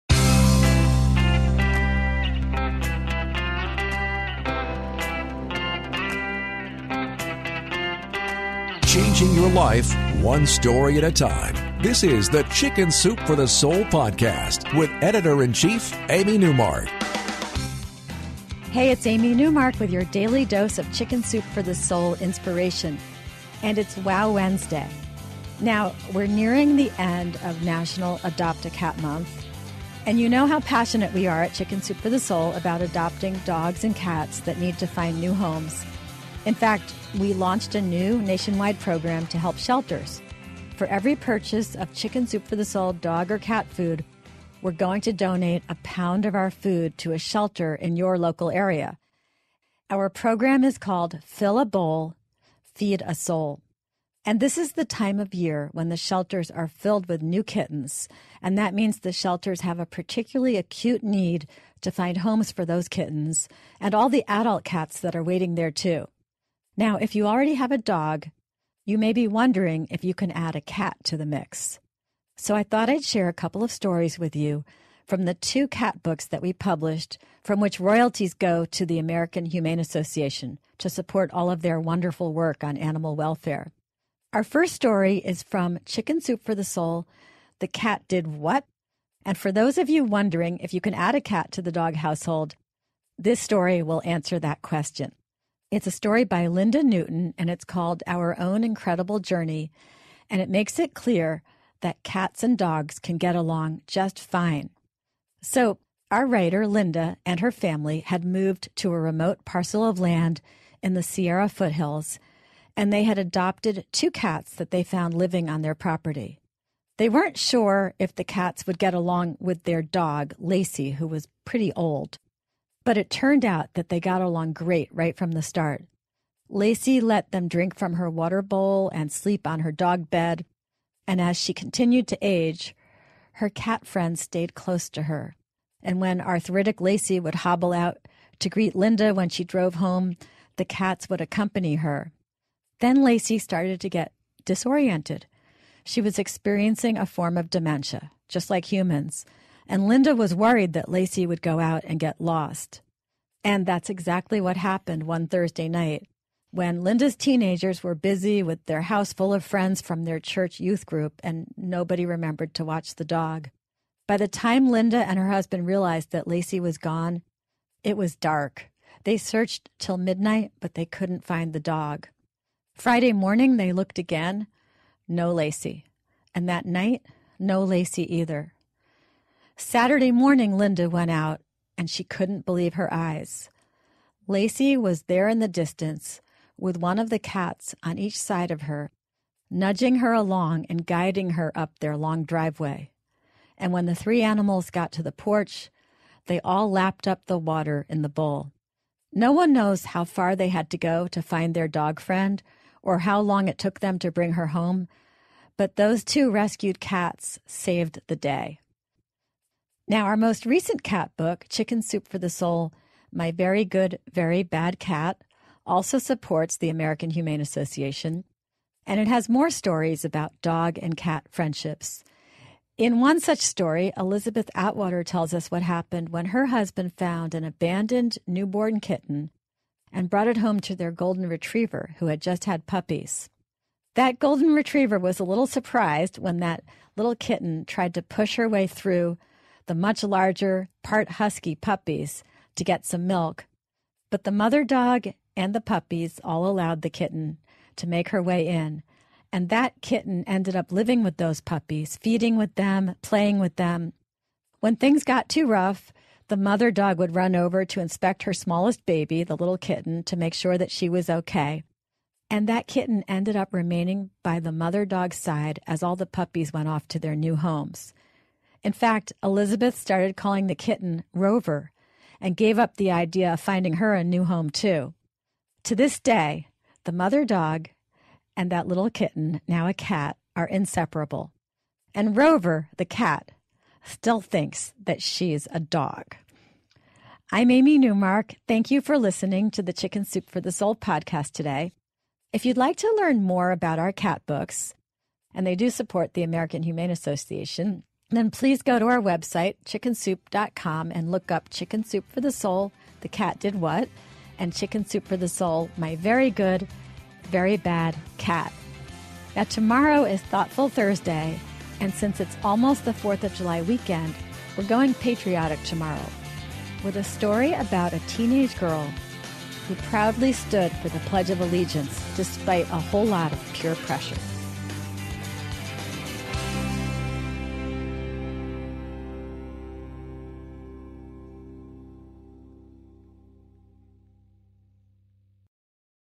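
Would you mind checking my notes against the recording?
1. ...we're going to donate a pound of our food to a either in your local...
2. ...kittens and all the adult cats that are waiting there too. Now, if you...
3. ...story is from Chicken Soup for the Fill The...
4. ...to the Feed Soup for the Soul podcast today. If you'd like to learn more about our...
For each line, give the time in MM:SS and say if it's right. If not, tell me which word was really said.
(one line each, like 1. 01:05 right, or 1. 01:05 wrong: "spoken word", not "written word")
1. 00:44 wrong: "shelter", not "either"
2. 01:02 right
3. 01:24 wrong: "Soul", not "Fill"
4. 04:49 wrong: "Chicken", not "Feed".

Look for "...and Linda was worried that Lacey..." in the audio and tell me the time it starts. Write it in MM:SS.
02:29.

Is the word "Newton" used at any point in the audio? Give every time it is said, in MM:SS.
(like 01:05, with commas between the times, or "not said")
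01:36.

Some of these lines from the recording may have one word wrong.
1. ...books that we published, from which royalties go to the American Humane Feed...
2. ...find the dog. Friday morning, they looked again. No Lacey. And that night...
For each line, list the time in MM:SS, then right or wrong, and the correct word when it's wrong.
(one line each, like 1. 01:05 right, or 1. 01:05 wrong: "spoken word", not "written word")
1. 01:16 wrong: "Association", not "Feed"
2. 02:51 right.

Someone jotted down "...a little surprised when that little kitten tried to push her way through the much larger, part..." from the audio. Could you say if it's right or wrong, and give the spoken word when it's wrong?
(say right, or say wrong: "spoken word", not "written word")
right.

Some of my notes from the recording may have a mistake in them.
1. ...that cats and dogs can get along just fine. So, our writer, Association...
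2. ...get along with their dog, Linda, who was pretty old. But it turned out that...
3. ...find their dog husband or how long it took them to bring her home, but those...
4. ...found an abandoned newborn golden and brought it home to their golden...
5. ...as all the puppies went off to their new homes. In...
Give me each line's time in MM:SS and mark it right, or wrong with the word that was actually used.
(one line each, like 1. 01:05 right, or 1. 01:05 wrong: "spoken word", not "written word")
1. 01:41 wrong: "Linda", not "Association"
2. 01:58 wrong: "Lacey", not "Linda"
3. 03:21 wrong: "friend", not "husband"
4. 03:46 wrong: "kitten", not "golden"
5. 04:25 right.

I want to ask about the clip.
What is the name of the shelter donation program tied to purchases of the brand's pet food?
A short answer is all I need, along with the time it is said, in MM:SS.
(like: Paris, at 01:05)
Fill a Bowl, Feed a Soul, at 00:51.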